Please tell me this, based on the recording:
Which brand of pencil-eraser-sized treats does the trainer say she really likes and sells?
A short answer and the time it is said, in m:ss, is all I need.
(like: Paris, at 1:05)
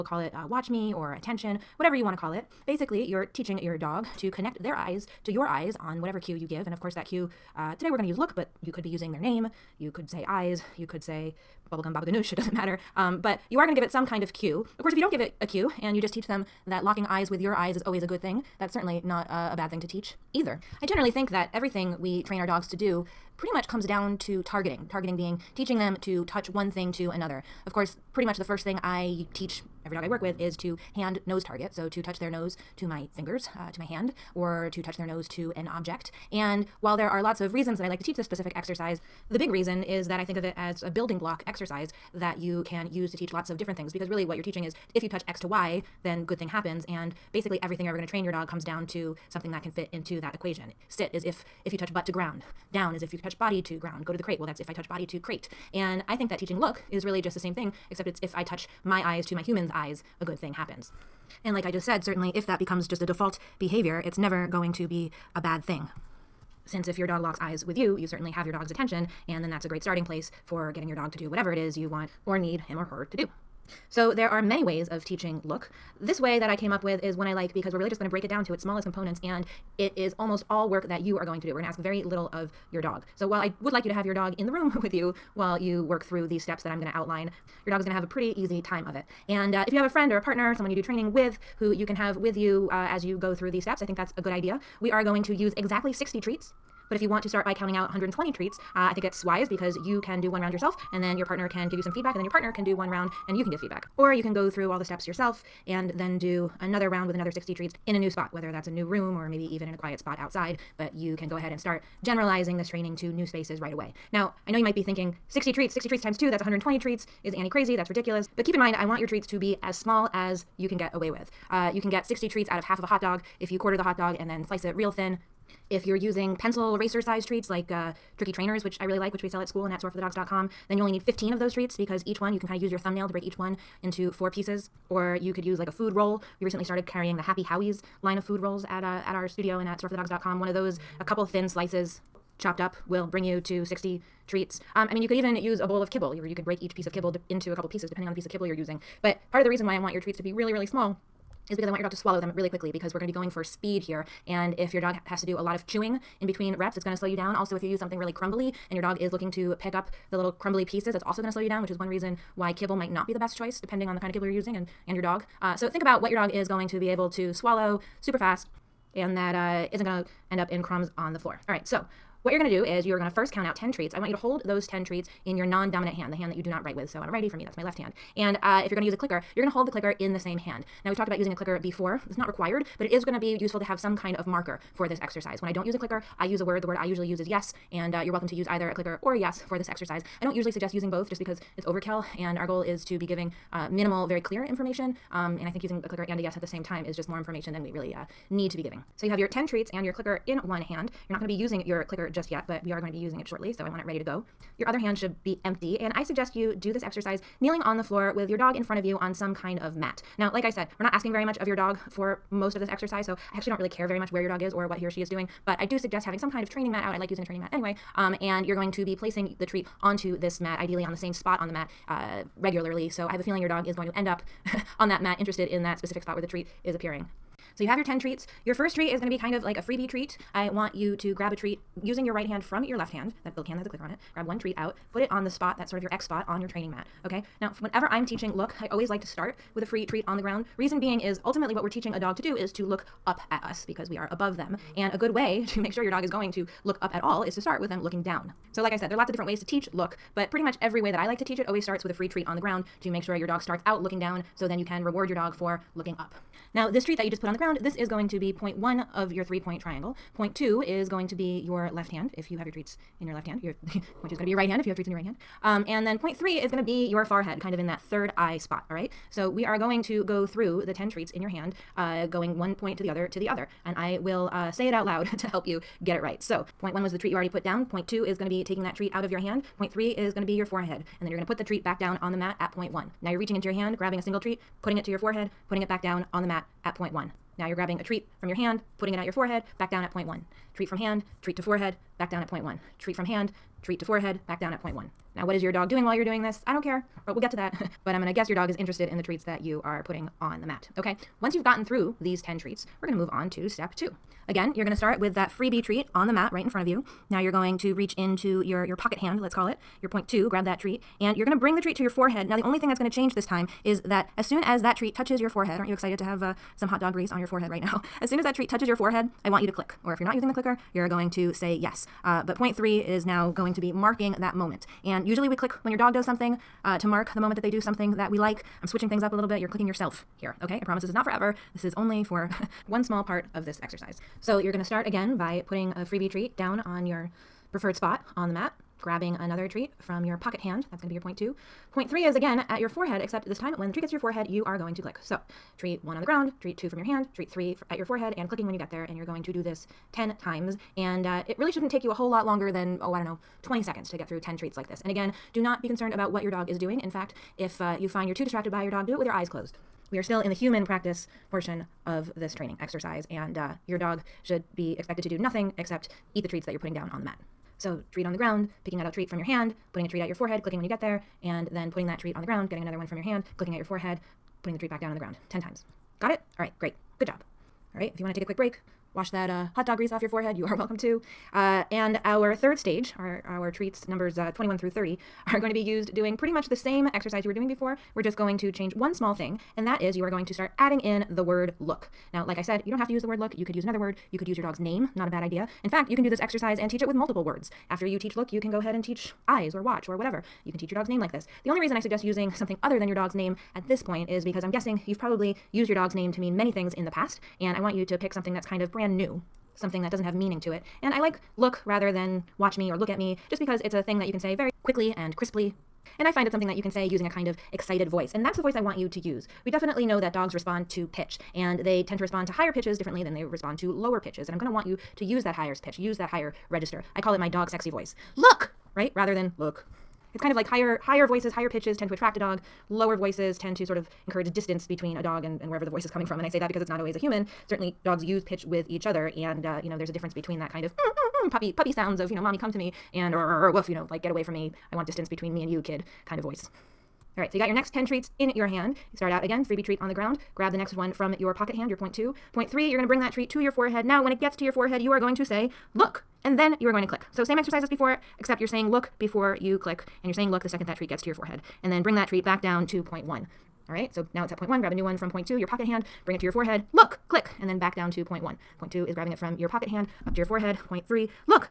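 tricky trainers, at 2:08.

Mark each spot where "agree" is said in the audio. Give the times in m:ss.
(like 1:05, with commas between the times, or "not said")
not said.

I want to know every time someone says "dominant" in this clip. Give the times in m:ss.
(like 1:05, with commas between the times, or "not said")
2:55.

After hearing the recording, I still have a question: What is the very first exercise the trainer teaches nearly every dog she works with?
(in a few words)
hand nose target.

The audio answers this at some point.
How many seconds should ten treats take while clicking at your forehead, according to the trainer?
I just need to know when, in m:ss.
5:53.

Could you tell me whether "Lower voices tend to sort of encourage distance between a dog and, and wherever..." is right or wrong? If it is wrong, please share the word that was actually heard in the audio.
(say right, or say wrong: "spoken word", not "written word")
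right.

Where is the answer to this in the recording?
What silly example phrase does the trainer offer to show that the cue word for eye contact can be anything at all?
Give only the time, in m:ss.
0:11.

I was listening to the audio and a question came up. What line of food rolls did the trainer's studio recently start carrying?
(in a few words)
Happy Howies.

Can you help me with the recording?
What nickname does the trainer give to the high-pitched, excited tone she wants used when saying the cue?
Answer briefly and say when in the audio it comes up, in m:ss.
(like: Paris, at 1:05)
dog sexy voice, at 7:07.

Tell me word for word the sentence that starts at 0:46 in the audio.
And basically, everything you're ever going to train your dog comes down to something that can fit into that equation.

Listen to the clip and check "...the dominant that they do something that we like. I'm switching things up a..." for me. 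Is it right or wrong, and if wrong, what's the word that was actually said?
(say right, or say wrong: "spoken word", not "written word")
wrong: "moment", not "dominant".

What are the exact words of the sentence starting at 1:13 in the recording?
So there are many ways of teaching look.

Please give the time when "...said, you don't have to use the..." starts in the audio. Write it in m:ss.
6:32.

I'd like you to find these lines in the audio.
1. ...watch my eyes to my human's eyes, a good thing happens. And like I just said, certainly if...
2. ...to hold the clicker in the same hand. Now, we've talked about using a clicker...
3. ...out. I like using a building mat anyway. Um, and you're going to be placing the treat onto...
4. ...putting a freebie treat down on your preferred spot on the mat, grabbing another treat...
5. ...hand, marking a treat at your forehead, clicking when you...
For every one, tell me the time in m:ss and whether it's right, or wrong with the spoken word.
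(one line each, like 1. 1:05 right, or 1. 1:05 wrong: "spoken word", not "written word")
1. 0:58 wrong: "touch", not "watch"
2. 2:59 right
3. 3:36 wrong: "training", not "building"
4. 5:35 right
5. 6:09 wrong: "putting", not "marking".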